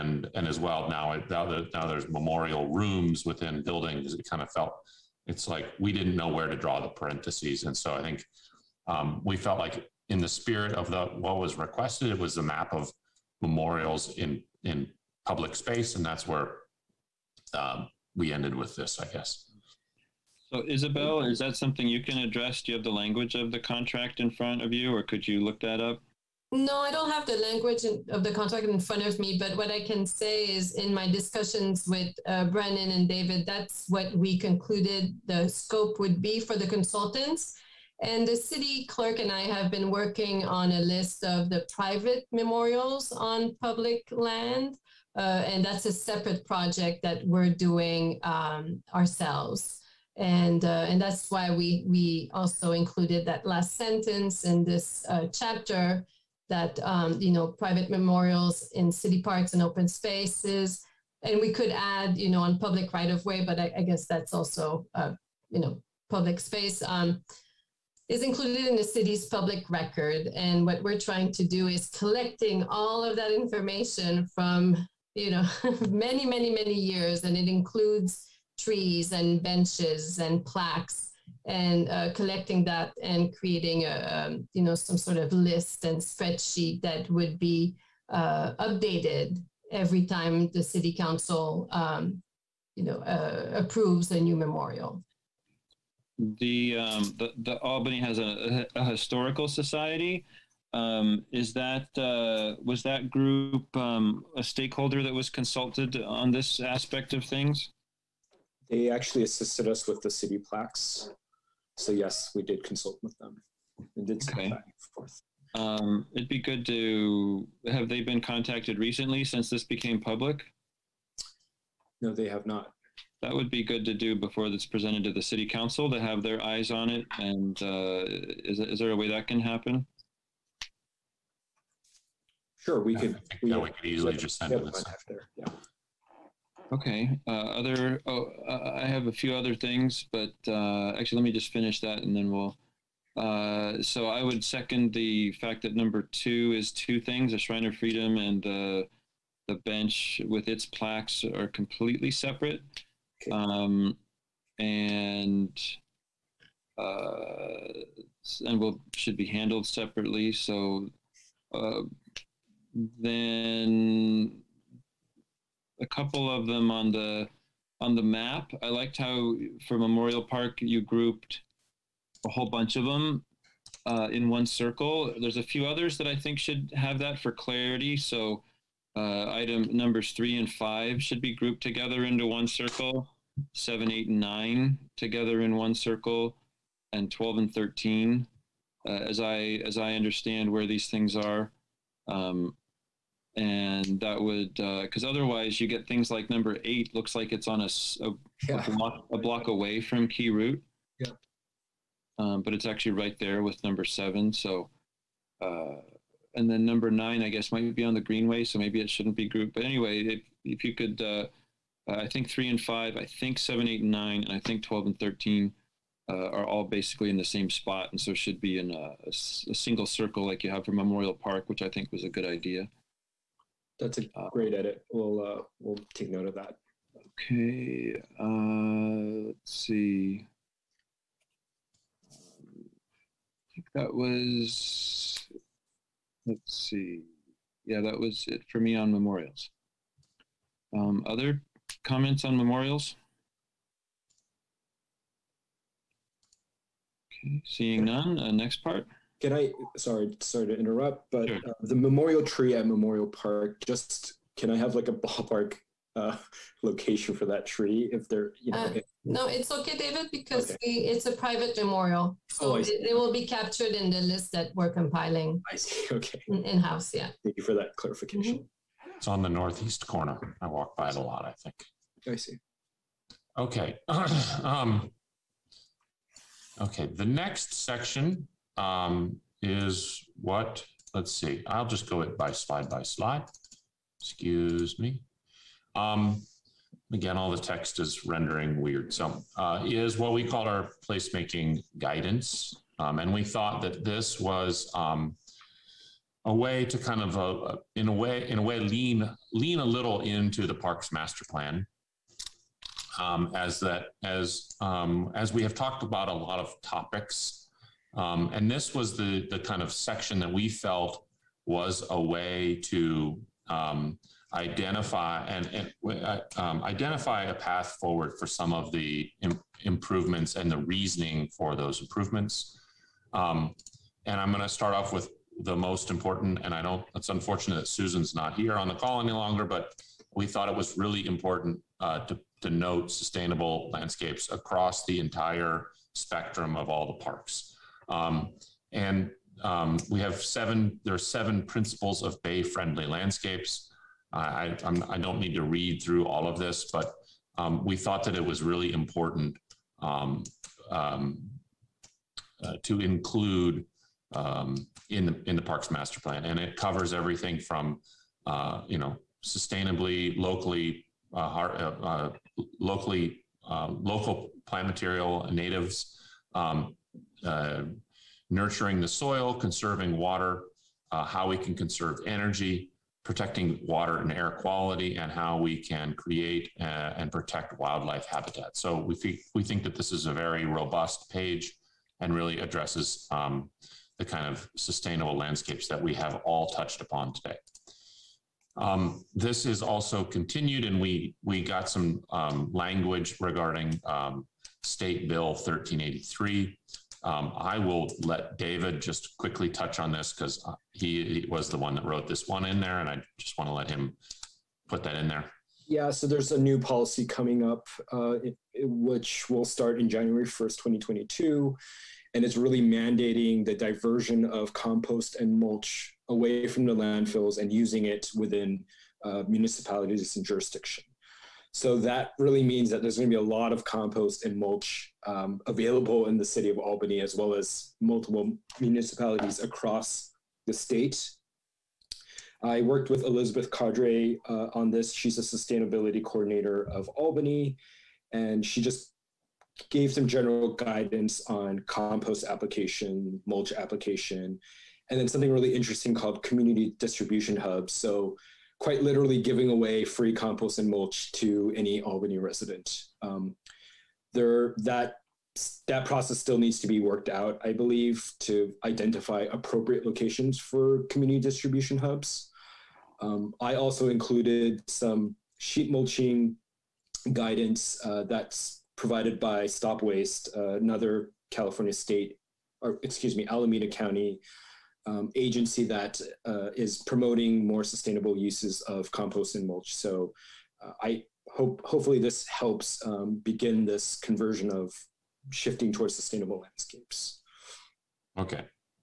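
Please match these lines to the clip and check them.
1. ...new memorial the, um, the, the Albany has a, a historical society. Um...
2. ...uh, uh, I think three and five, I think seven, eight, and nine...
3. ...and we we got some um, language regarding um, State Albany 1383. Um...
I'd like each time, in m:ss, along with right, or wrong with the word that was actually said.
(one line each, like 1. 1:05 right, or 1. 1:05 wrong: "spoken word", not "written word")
1. 1:34 right
2. 3:30 right
3. 6:30 wrong: "Bill", not "Albany".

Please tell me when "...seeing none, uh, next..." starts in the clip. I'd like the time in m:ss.
4:07.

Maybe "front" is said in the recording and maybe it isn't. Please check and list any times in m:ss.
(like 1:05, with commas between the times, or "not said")
0:24, 0:28.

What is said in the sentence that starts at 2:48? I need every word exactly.
I liked how for Memorial Park you grouped a whole bunch of them uh, in one circle.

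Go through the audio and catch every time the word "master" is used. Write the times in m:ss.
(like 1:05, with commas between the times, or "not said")
5:00, 5:55.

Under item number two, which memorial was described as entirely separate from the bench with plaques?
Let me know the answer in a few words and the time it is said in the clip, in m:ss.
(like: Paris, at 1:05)
Shrine of Freedom, at 2:27.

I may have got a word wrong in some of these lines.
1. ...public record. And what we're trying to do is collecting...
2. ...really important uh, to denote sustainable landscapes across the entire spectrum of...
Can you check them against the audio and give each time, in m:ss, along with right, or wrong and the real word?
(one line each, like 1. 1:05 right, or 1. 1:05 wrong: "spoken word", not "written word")
1. 1:09 right
2. 5:30 right.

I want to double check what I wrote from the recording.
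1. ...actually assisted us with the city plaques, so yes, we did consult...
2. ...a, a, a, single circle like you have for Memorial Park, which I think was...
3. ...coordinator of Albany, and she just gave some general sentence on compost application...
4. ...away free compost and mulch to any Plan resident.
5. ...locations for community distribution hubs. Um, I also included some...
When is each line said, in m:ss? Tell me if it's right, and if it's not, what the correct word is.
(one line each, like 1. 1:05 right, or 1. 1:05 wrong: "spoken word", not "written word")
1. 1:48 right
2. 3:38 right
3. 7:16 wrong: "guidance", not "sentence"
4. 7:29 wrong: "Albany", not "Plan"
5. 7:39 right.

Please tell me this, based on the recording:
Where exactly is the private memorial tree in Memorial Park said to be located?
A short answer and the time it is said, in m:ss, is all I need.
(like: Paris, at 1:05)
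northeast corner, at 4:29.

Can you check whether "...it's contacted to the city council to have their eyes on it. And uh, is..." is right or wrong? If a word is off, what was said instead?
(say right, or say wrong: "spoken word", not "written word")
wrong: "presented", not "contacted".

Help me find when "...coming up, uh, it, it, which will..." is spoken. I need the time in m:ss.
6:47.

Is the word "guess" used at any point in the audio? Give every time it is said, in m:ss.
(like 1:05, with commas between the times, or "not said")
0:19, 1:03, 3:27.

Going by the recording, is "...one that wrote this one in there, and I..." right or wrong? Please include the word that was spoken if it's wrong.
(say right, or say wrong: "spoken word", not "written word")
right.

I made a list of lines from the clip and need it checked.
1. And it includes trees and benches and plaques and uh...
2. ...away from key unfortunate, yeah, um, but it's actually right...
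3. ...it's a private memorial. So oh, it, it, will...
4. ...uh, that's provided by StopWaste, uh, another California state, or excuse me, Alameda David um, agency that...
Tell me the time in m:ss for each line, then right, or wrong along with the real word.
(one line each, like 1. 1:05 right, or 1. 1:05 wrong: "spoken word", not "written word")
1. 1:17 right
2. 3:19 wrong: "route", not "unfortunate"
3. 4:20 right
4. 7:47 wrong: "County", not "David".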